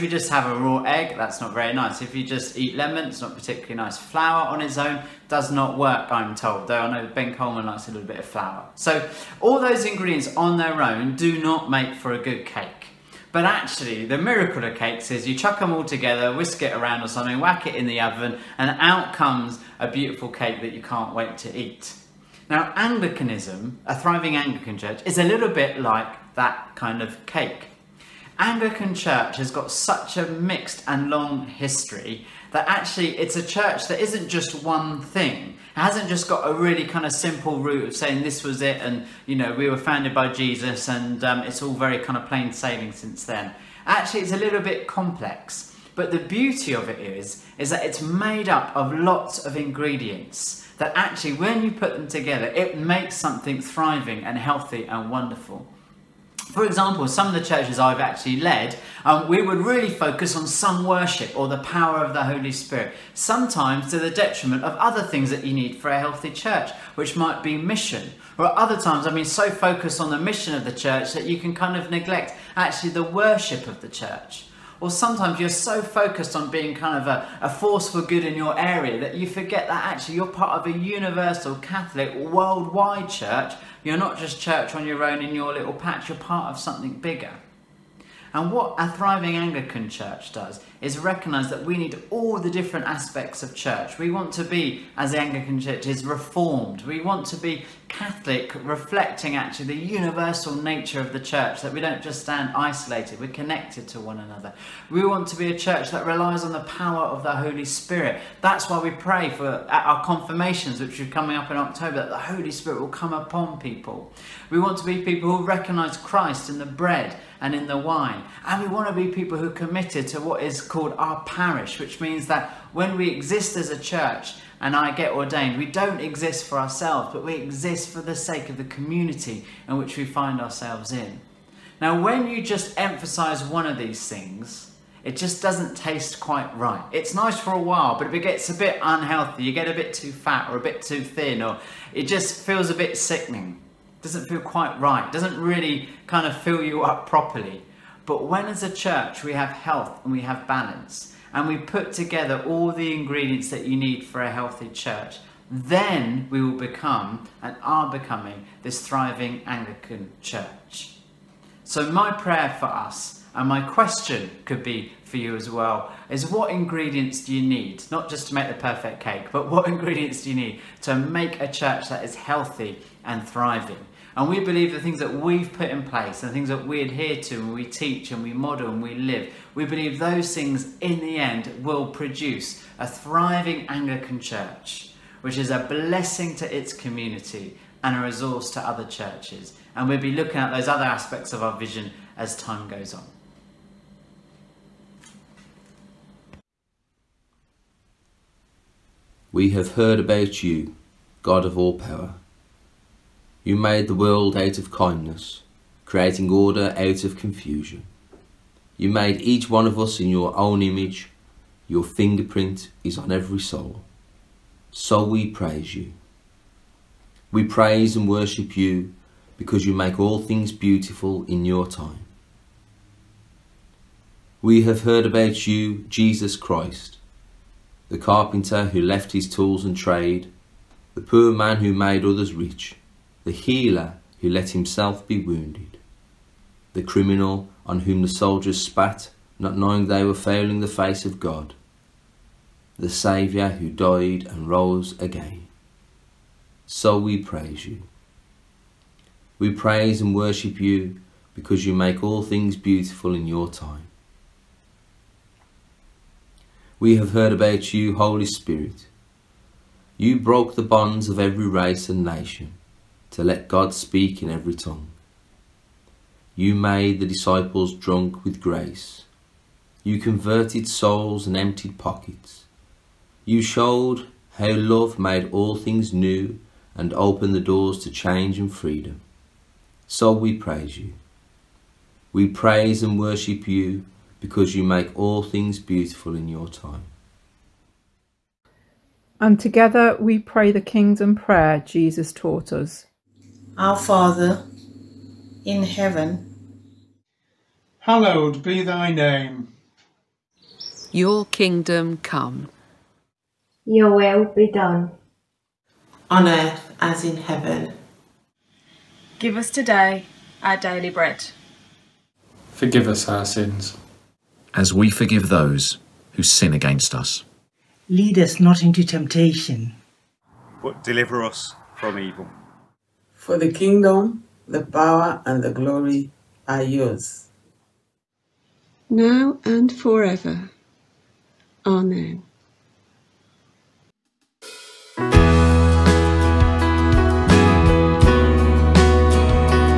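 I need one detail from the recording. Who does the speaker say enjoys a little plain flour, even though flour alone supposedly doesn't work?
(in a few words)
Ben Coleman.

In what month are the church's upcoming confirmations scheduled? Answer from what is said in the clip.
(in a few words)
October.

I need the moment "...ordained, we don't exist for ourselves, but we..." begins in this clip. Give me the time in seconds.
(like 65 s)
125 s.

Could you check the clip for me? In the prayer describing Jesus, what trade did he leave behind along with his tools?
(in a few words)
carpenter.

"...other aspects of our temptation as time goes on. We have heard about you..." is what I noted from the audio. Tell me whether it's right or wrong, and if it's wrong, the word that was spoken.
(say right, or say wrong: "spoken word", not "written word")
wrong: "vision", not "temptation".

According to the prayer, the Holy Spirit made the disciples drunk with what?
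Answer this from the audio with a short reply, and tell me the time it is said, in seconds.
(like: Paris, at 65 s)
grace, at 268 s.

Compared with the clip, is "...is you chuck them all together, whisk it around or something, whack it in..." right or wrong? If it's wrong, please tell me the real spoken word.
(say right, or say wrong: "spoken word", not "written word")
right.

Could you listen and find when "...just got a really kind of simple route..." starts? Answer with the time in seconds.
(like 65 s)
36 s.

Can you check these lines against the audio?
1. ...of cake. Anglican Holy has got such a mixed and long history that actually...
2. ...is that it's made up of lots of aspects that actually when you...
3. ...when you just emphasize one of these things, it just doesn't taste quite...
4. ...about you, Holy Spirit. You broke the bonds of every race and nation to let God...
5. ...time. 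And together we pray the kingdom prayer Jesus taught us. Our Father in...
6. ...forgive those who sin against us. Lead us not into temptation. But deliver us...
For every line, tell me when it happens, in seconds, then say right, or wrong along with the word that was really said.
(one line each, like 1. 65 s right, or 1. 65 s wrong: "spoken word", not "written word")
1. 27 s wrong: "Church", not "Holy"
2. 47 s wrong: "ingredients", not "aspects"
3. 131 s right
4. 257 s right
5. 286 s right
6. 314 s right.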